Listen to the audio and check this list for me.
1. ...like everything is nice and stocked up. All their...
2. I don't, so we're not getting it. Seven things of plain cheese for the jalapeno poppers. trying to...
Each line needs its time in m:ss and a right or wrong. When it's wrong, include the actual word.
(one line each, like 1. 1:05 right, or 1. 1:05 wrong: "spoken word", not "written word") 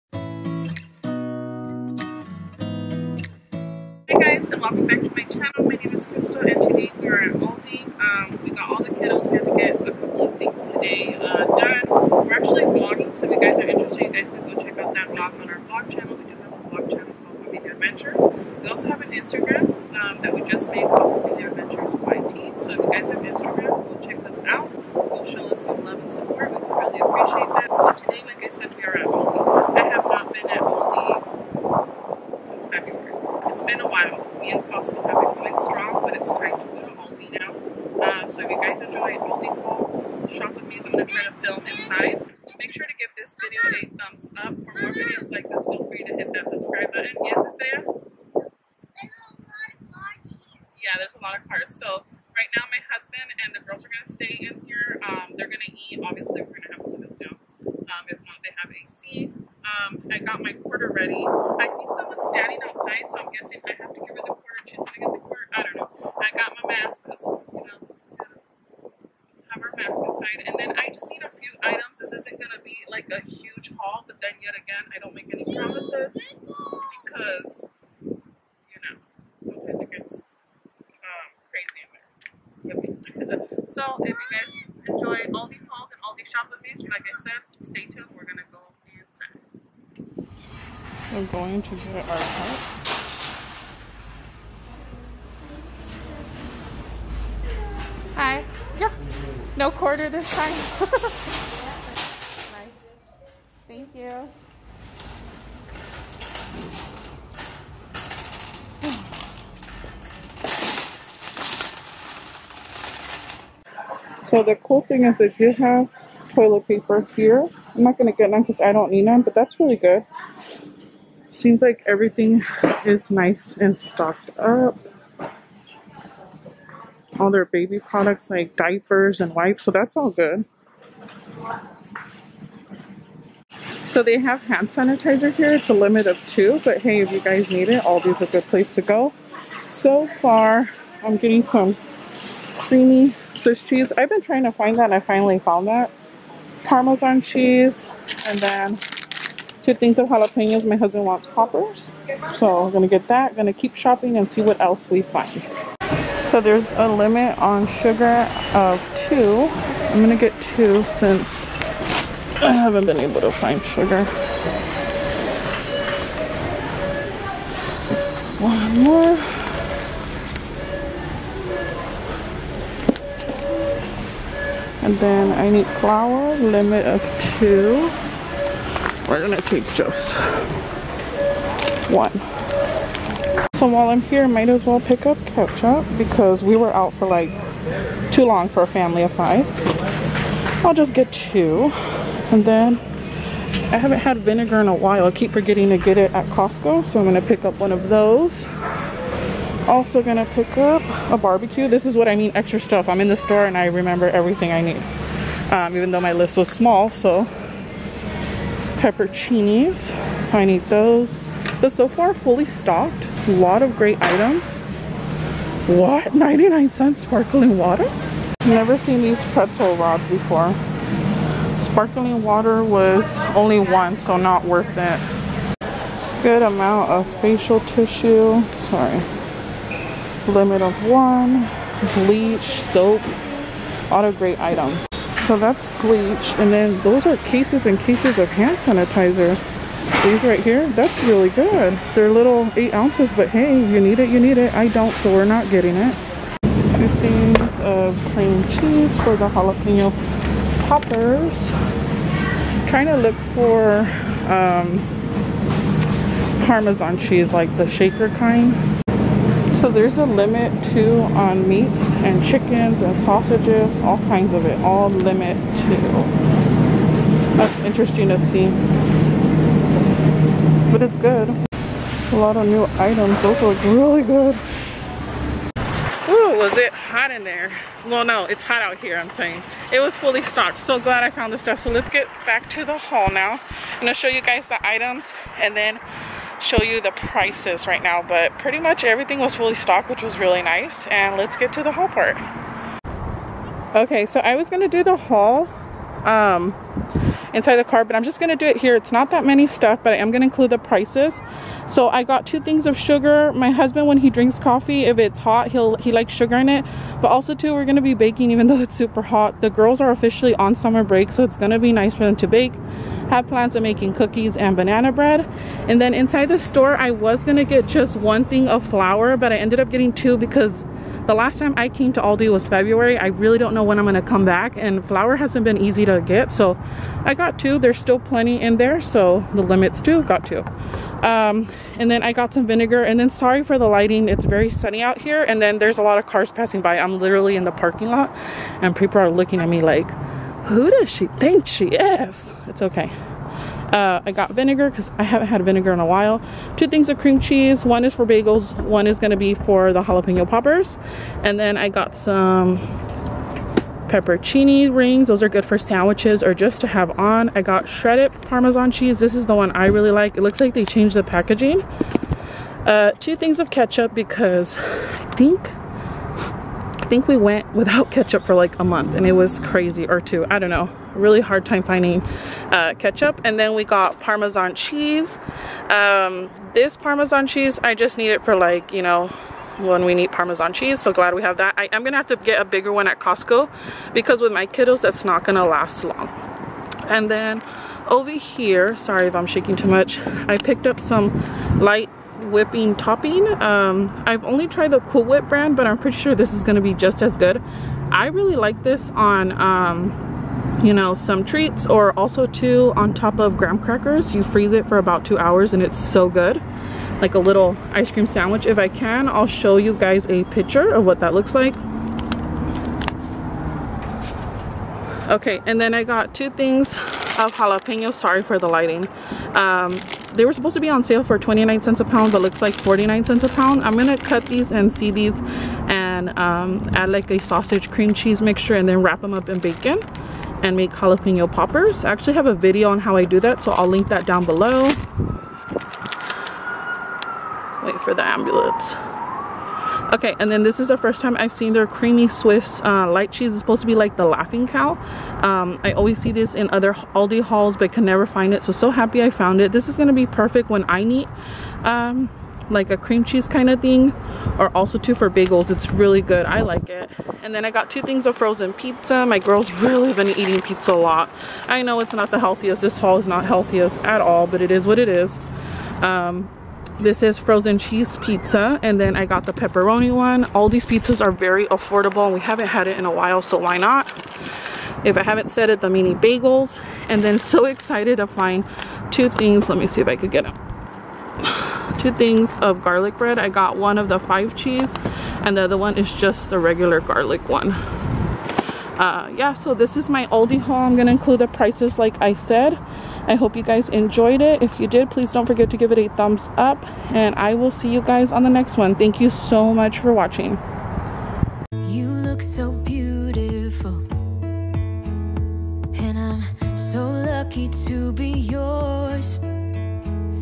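1. 2:01 right
2. 4:04 wrong: "Two", not "Seven".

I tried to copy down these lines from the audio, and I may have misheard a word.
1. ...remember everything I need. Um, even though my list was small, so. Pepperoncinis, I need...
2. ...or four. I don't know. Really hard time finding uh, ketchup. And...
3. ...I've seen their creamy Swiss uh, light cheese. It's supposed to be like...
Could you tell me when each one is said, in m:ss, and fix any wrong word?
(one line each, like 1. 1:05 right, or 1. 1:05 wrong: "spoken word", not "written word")
1. 3:23 right
2. 6:09 wrong: "two", not "four"
3. 7:21 right.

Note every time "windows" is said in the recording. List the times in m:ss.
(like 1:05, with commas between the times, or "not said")
0:56.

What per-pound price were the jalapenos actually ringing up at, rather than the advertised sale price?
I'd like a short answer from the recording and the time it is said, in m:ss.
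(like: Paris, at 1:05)
49 cents, at 7:02.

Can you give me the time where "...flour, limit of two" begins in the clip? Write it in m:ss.
2:55.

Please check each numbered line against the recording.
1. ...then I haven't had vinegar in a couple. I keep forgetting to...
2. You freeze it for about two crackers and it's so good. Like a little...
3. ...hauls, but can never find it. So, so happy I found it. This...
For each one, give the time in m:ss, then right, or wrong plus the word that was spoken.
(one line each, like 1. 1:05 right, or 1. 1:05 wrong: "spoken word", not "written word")
1. 3:12 wrong: "while", not "couple"
2. 6:44 wrong: "hours", not "crackers"
3. 7:27 right.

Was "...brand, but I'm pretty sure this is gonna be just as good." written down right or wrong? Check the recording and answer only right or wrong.
right.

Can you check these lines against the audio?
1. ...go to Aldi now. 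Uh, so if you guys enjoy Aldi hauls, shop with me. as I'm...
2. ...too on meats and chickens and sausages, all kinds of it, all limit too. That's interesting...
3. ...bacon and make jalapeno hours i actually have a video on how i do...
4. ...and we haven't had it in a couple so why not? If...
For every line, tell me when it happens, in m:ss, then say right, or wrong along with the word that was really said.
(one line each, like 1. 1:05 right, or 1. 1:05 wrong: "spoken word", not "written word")
1. 0:36 right
2. 4:20 right
3. 7:09 wrong: "poppers", not "hours"
4. 7:52 wrong: "while", not "couple".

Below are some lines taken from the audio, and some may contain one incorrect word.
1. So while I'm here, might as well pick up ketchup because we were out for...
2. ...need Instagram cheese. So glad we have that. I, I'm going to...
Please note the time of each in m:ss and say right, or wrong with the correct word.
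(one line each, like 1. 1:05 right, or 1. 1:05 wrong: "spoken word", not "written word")
1. 3:03 right
2. 6:19 wrong: "Parmesan", not "Instagram".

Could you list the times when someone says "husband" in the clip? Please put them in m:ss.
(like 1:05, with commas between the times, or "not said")
0:52, 2:30, 5:03.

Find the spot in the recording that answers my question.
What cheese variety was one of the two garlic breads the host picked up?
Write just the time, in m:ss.
8:03.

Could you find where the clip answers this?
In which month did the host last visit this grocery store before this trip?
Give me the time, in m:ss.
5:22.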